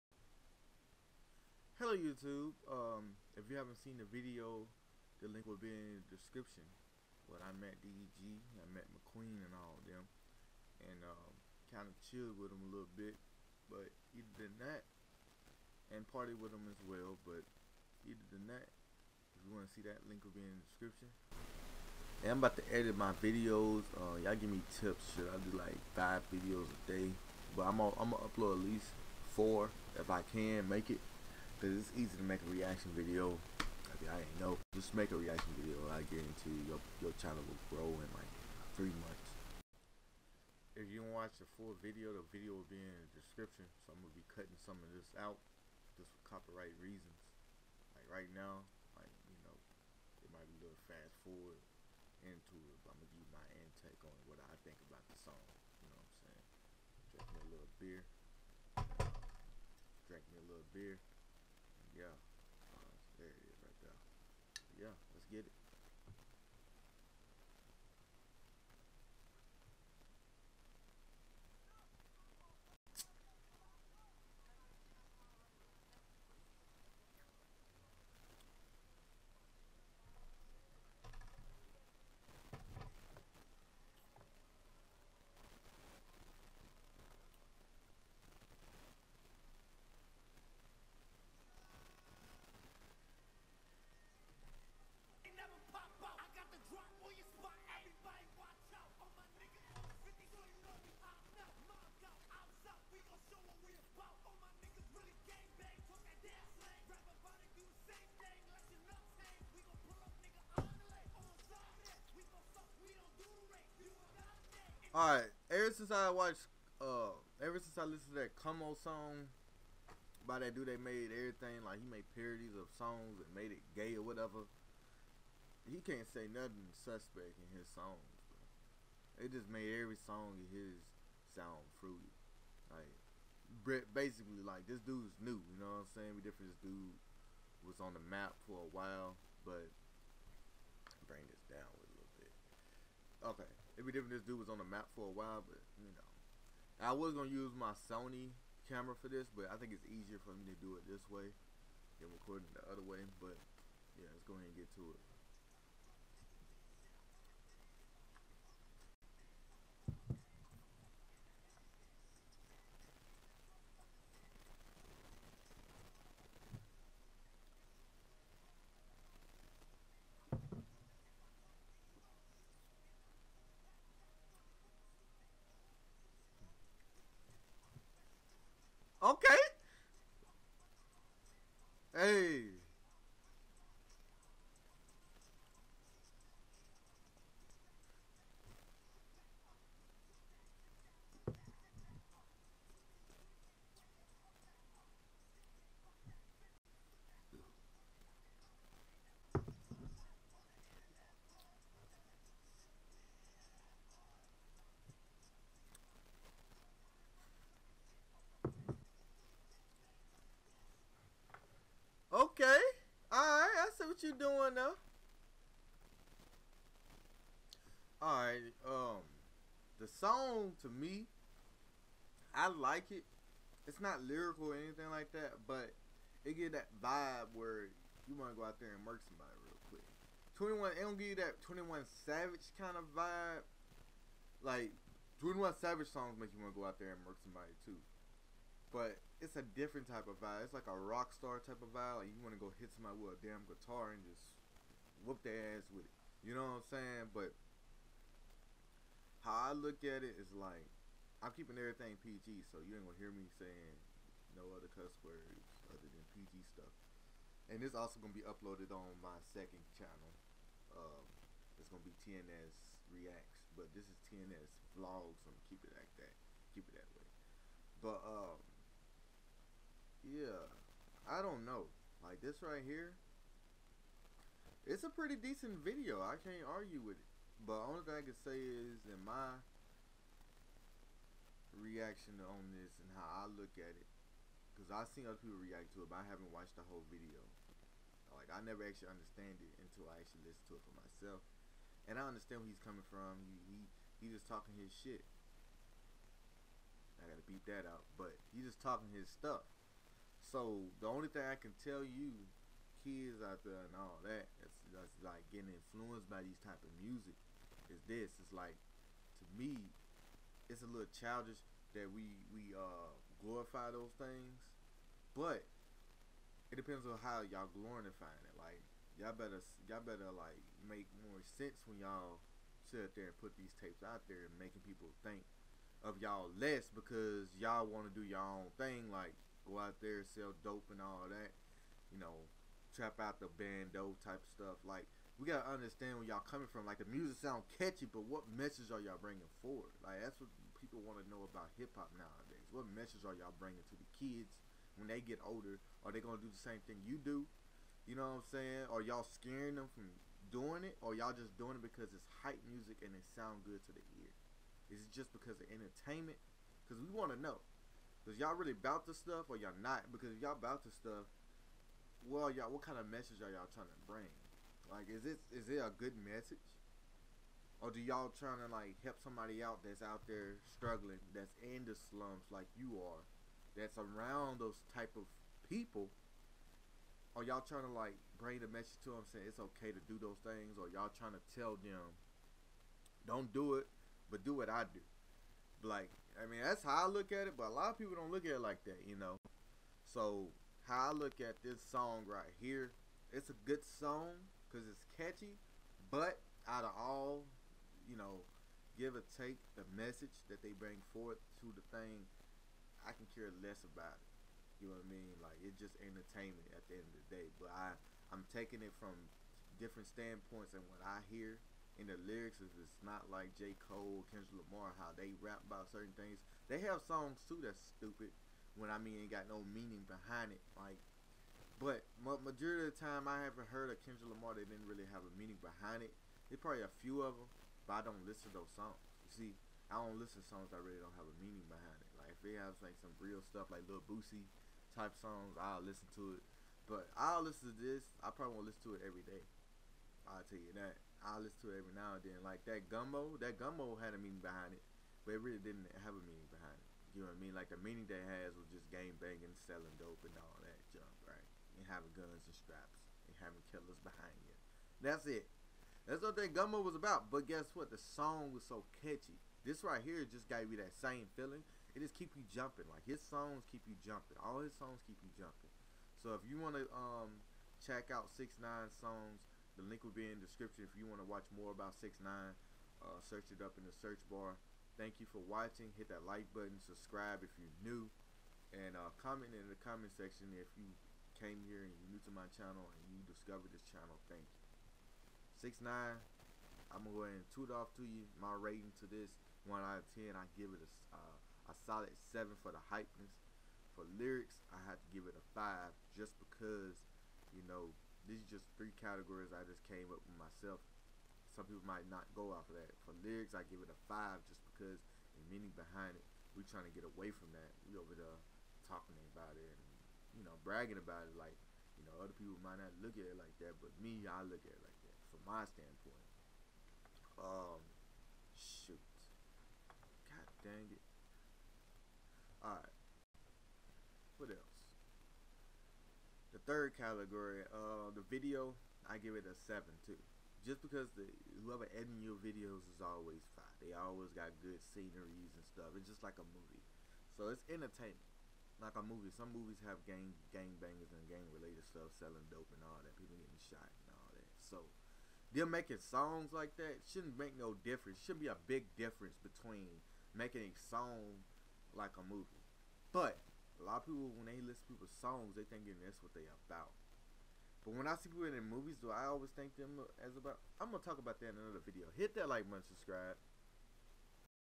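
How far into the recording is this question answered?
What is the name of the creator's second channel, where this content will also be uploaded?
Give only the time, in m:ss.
4:22.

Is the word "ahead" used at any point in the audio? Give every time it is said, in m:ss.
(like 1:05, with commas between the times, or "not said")
2:34, 8:07.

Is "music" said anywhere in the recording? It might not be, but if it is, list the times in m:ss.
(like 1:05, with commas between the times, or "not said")
5:06, 5:36, 5:52.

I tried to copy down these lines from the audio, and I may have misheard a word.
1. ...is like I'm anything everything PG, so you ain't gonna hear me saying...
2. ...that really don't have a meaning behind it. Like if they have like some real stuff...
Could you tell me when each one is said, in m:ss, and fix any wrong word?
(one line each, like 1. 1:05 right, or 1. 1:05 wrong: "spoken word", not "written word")
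1. 4:10 wrong: "keeping", not "anything"
2. 7:10 right.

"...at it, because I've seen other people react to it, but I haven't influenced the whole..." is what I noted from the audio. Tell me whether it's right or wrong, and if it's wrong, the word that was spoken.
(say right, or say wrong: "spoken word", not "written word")
wrong: "watched", not "influenced".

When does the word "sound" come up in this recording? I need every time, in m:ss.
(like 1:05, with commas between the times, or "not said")
2:11, 5:37, 5:53.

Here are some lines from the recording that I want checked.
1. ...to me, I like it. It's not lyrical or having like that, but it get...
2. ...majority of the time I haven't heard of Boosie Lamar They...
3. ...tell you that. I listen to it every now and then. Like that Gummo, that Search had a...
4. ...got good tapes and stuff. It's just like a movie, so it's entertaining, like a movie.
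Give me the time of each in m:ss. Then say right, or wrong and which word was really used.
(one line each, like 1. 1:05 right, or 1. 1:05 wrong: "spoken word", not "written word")
1. 3:40 wrong: "anything", not "having"
2. 7:02 wrong: "Kendrick", not "Boosie"
3. 7:20 wrong: "Gummo", not "Search"
4. 8:54 wrong: "sceneries", not "tapes".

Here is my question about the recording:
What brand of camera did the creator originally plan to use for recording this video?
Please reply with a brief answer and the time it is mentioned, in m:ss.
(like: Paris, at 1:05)
Sony, at 2:27.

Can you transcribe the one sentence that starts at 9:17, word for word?
But when I see people in their movies, do I always think them as about?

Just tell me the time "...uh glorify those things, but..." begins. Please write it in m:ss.
5:12.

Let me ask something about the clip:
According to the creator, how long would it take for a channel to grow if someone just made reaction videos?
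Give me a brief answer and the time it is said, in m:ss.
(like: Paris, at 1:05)
3 months, at 0:38.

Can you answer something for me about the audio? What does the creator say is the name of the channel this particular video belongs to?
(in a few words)
T&S Vlogs.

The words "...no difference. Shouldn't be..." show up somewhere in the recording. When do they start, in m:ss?
9:07.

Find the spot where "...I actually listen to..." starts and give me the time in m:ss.
4:49.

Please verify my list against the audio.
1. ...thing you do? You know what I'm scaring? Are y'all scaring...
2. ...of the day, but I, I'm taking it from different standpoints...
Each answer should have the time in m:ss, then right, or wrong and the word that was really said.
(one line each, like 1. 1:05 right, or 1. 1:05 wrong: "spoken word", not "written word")
1. 5:46 wrong: "saying", not "scaring"
2. 6:46 right.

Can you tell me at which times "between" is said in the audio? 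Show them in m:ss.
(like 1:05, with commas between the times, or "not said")
9:09.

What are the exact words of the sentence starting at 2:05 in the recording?
He can't say nothing suspect in his songs.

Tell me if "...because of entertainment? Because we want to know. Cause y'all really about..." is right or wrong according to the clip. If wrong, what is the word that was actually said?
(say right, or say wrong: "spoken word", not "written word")
right.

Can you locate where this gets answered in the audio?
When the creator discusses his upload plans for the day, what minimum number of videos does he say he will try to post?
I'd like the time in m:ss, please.
0:29.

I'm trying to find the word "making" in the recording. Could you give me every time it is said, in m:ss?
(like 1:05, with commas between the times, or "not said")
5:24, 9:05, 9:10.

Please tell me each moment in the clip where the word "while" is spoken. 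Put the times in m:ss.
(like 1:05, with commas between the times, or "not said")
2:18, 2:25.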